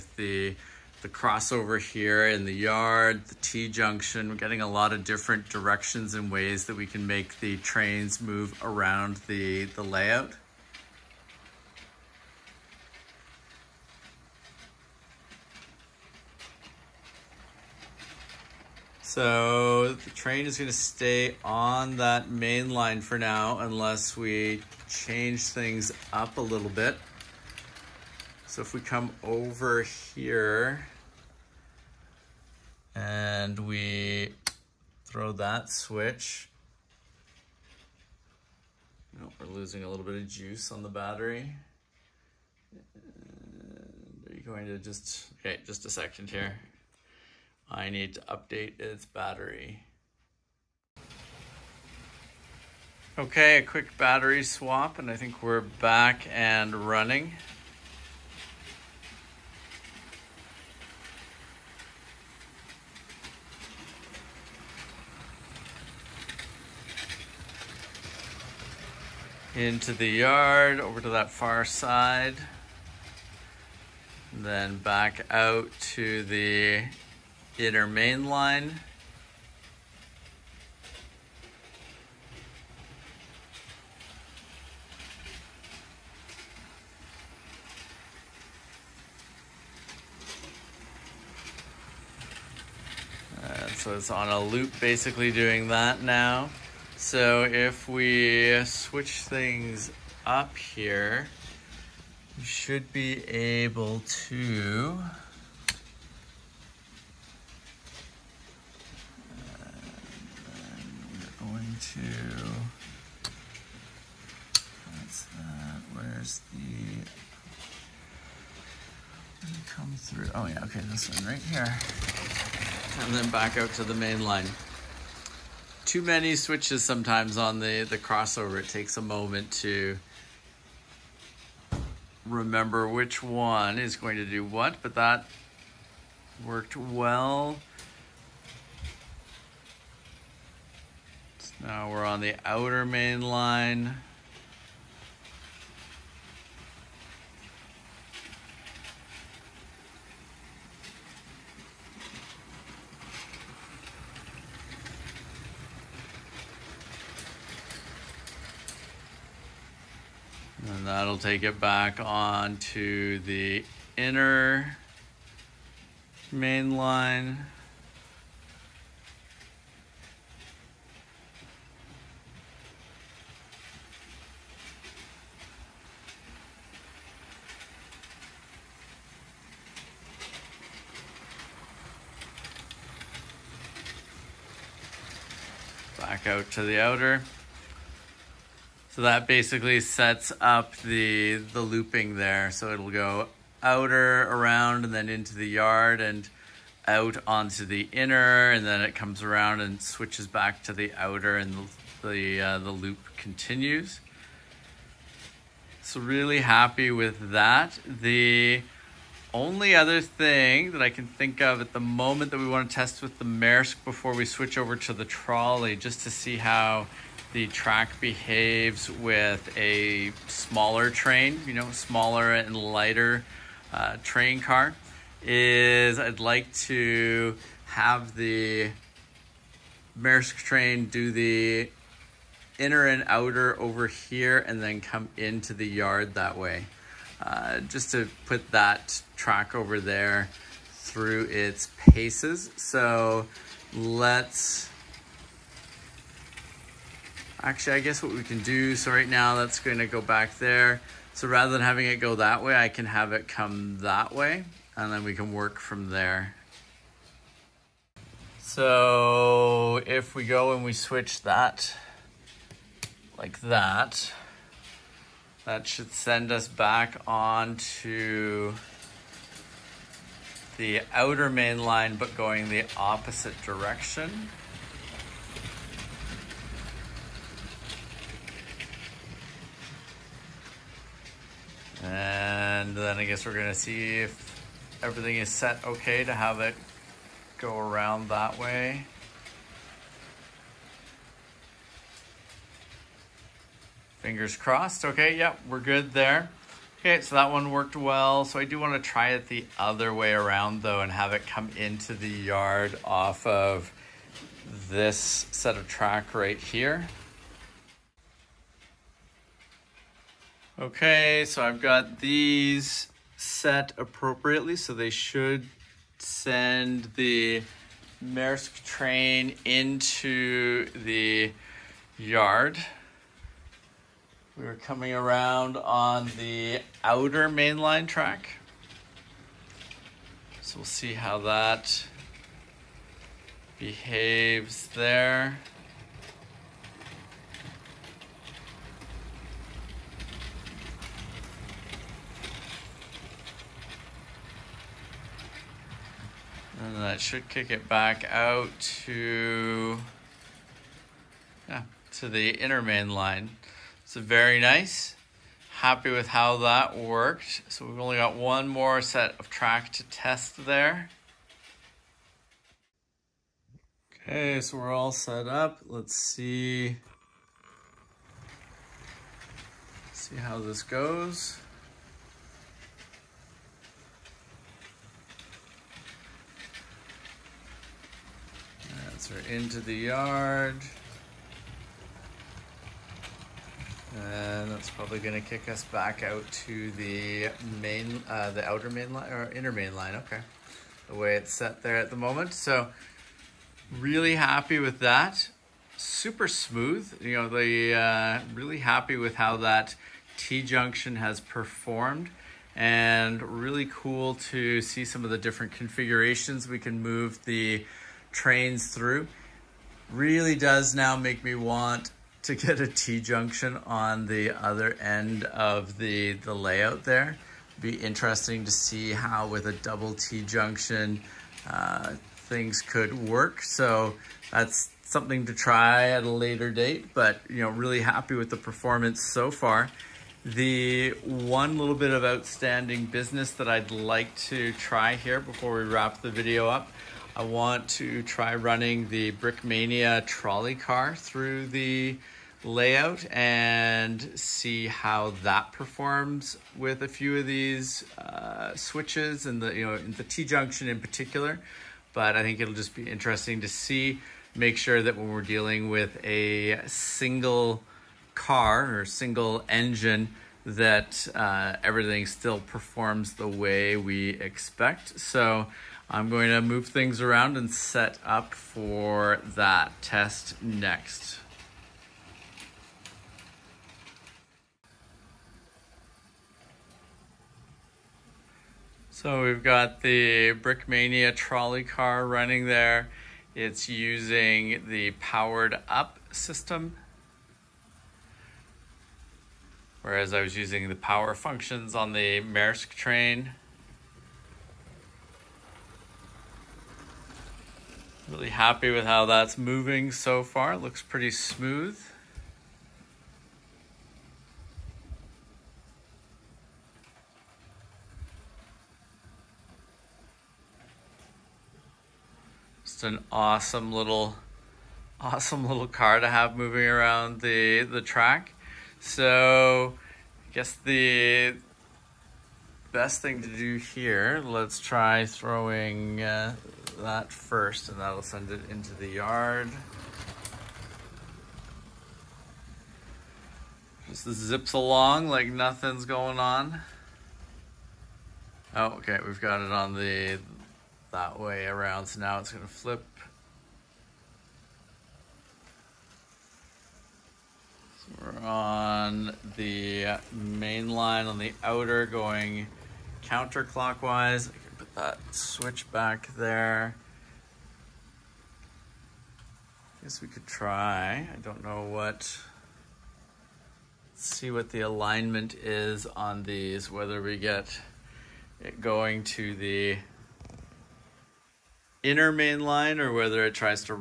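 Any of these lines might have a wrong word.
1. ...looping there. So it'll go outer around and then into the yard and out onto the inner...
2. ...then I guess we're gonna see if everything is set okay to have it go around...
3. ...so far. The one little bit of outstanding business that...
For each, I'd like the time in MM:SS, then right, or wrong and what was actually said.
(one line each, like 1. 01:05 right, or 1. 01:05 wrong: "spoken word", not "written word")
1. 03:11 right
2. 04:42 right
3. 07:09 right.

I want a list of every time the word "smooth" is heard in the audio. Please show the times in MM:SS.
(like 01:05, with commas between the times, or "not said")
06:36, 08:21.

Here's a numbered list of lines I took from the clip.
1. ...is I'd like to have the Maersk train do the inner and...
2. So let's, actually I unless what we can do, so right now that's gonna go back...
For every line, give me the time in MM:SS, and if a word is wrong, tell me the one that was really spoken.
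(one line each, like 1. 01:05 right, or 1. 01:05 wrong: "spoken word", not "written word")
1. 03:45 right
2. 04:02 wrong: "guess", not "unless".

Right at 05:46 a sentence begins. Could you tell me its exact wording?
And that should kick it back out to, yeah, to the inner main line.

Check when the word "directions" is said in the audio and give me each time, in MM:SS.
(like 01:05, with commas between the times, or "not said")
00:05, 04:33.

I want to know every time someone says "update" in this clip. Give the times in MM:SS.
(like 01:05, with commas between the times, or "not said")
00:48.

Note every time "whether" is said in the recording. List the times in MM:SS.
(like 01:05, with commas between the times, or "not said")
09:26, 09:32.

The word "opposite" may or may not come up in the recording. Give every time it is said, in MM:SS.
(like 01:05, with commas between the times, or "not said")
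04:32.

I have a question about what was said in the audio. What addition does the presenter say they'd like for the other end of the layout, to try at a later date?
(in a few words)
Double T-junction.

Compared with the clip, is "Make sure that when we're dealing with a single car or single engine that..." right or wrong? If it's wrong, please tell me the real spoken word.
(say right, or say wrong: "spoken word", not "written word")
right.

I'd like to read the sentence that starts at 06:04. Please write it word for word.
Okay, so we're all set up.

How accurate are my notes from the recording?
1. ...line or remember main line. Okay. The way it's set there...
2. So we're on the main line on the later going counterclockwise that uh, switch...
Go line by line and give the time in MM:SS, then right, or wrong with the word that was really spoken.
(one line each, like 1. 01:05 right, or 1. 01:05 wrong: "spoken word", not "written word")
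1. 06:28 wrong: "inner", not "remember"
2. 09:07 wrong: "outer", not "later".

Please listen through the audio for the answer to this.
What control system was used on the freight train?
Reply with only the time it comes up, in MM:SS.
08:10.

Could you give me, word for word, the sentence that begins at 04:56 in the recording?
Okay, so that one worked well.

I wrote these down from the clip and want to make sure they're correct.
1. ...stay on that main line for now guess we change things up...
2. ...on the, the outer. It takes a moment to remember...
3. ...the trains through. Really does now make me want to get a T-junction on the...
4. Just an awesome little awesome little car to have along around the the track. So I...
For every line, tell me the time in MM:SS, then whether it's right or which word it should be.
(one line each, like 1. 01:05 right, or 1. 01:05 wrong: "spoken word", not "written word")
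1. 00:20 wrong: "unless", not "guess"
2. 02:07 wrong: "crossover", not "outer"
3. 06:47 right
4. 08:32 wrong: "moving", not "along".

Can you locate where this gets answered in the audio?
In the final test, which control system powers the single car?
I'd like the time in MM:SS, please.
08:04.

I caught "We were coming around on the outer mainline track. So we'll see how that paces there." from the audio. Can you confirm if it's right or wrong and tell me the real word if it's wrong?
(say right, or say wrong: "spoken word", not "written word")
wrong: "behaves", not "paces".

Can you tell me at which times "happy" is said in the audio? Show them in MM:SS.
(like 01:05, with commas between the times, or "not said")
03:26, 05:55, 06:34, 06:38, 07:07, 08:18.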